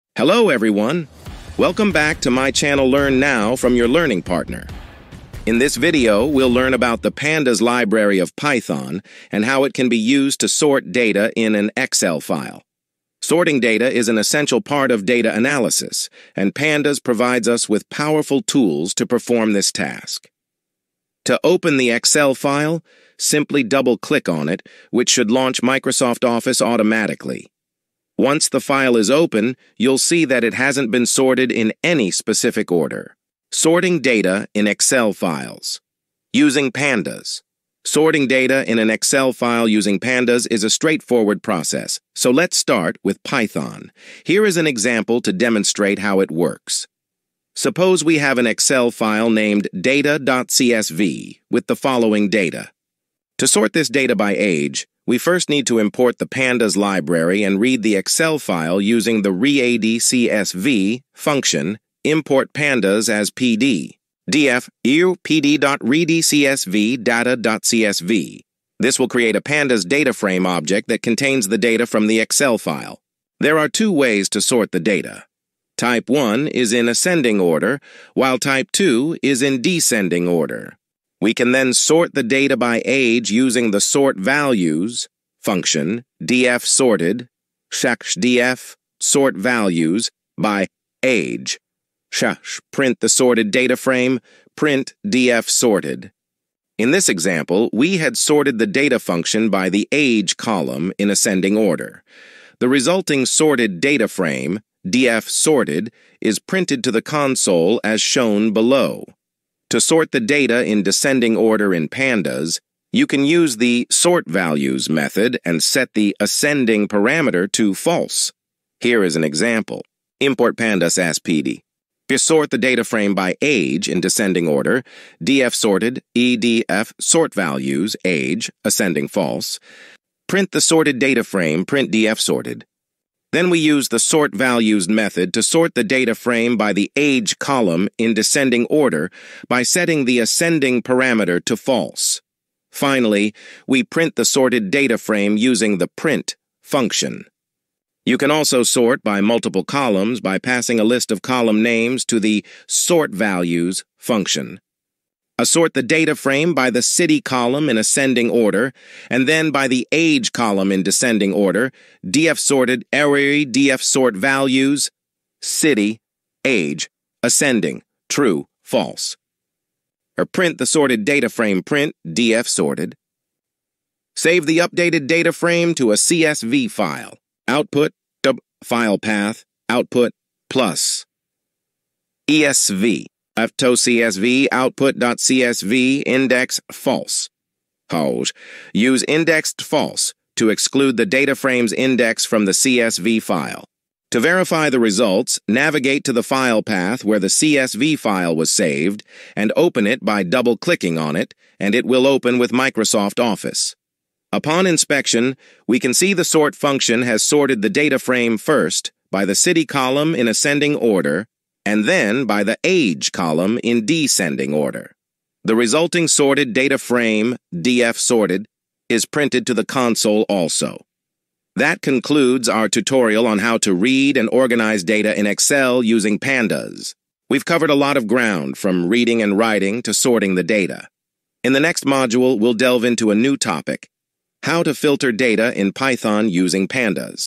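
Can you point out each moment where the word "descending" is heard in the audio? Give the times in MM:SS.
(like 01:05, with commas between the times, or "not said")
01:19, 01:50, 02:04, 02:18, 02:40, 03:33.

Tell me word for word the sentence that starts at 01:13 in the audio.
There are two ways to sort the data.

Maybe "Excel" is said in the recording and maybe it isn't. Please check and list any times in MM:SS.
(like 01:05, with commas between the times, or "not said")
00:11, 00:21, 00:34, 00:38, 00:48, 00:57, 01:12, 03:45.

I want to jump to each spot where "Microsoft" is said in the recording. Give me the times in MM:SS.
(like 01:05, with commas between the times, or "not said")
00:25, 03:22.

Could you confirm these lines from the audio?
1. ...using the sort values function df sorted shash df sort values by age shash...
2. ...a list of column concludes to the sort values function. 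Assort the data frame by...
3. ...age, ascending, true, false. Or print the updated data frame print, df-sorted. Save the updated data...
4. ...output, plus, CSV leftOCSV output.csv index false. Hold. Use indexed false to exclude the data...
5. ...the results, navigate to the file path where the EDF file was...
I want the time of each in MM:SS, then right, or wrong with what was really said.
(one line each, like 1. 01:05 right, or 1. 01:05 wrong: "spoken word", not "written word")
1. 01:23 right
2. 02:30 wrong: "names", not "concludes"
3. 02:46 wrong: "sorted", not "updated"
4. 02:59 right
5. 03:14 wrong: "CSV", not "EDF".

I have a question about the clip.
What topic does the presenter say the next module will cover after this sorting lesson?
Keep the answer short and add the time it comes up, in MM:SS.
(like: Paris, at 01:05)
filter data, at 03:54.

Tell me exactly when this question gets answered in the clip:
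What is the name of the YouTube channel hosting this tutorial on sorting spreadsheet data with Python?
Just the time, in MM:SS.
00:02.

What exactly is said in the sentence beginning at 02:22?
Finally, we print the sorted data frame using the print function.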